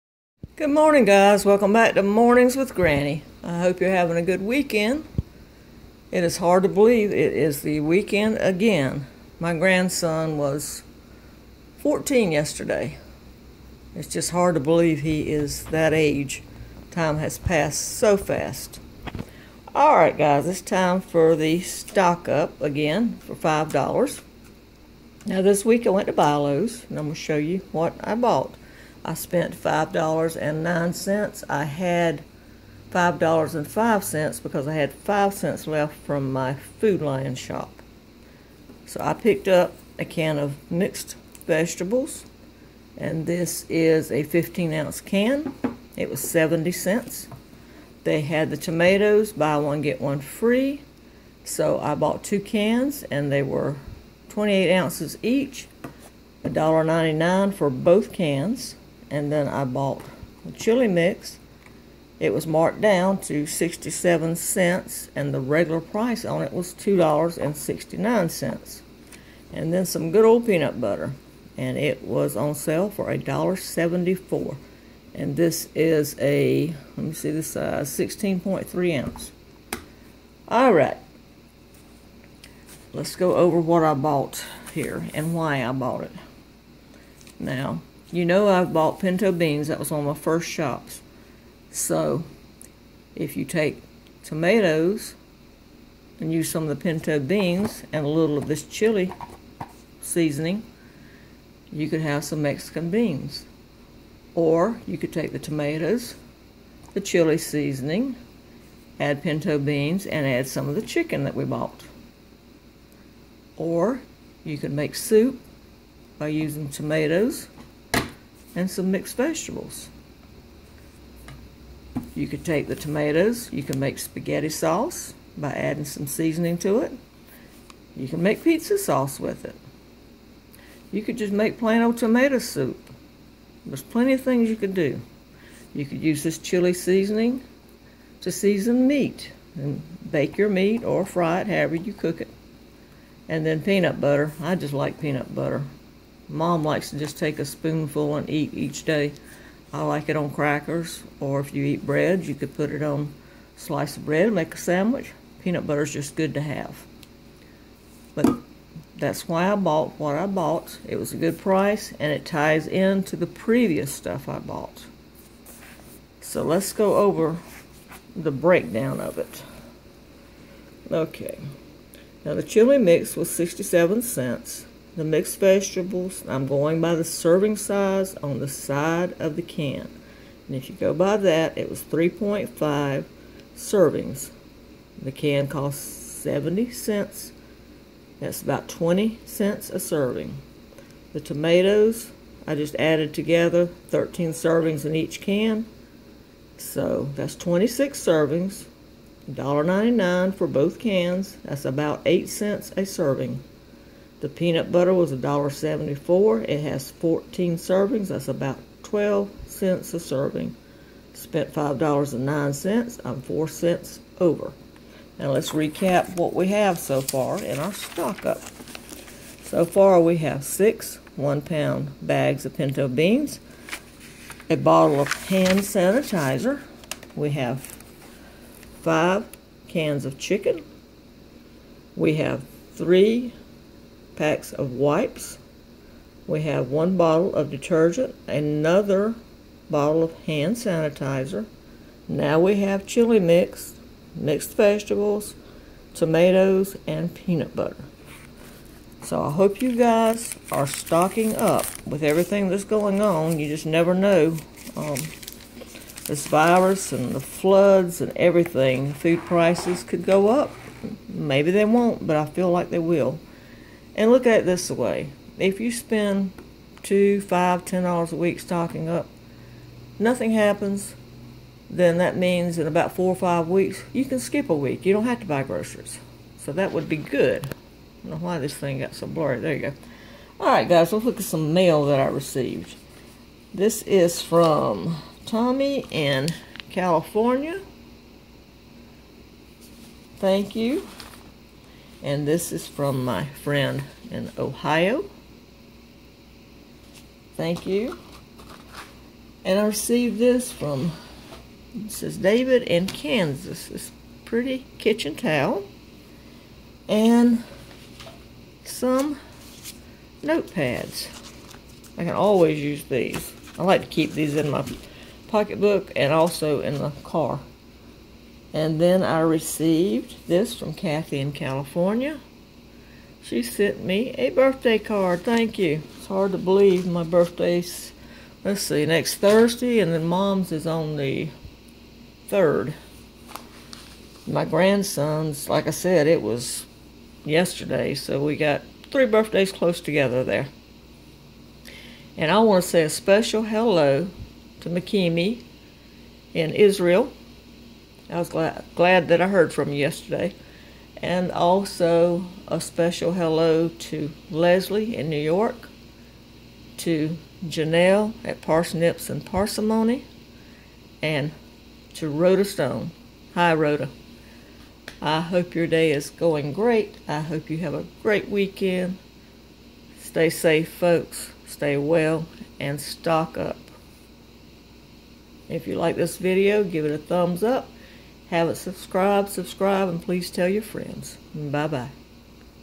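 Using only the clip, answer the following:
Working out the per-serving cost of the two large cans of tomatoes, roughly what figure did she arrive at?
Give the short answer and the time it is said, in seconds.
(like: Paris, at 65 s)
8 cents, at 202 s.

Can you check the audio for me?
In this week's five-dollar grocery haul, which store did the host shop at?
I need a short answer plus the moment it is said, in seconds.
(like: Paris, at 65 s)
Bilo's, at 26 s.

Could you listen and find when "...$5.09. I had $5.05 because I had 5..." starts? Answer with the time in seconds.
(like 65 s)
29 s.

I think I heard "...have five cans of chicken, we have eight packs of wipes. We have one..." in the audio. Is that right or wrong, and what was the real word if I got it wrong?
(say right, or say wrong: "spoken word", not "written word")
wrong: "three", not "eight".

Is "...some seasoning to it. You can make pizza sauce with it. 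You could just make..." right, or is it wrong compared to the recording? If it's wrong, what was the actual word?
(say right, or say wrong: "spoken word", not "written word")
right.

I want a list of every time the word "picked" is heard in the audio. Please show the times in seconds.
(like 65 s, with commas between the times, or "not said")
39 s.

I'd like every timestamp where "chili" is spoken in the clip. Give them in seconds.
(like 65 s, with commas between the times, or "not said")
60 s, 98 s, 106 s, 136 s, 172 s, 242 s.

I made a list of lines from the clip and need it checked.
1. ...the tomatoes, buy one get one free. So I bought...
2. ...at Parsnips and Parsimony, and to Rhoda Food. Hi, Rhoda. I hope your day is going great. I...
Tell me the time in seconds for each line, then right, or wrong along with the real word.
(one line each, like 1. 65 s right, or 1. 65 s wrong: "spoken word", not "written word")
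1. 48 s right
2. 358 s wrong: "Stone", not "Food".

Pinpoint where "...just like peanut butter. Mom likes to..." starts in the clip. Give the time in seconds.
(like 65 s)
144 s.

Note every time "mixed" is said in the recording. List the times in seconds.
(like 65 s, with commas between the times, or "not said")
40 s, 118 s, 175 s, 244 s.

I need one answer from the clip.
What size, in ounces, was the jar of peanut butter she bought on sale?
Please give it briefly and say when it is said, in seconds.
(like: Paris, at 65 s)
16.3 ounces, at 77 s.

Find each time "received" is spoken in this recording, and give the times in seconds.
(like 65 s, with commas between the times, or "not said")
282 s, 299 s, 319 s.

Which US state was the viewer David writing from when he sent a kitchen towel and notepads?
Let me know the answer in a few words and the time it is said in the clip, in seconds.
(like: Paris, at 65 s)
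Kansas, at 302 s.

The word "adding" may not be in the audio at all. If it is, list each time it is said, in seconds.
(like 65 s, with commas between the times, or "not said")
125 s.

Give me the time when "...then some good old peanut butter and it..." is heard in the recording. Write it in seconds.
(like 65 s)
69 s.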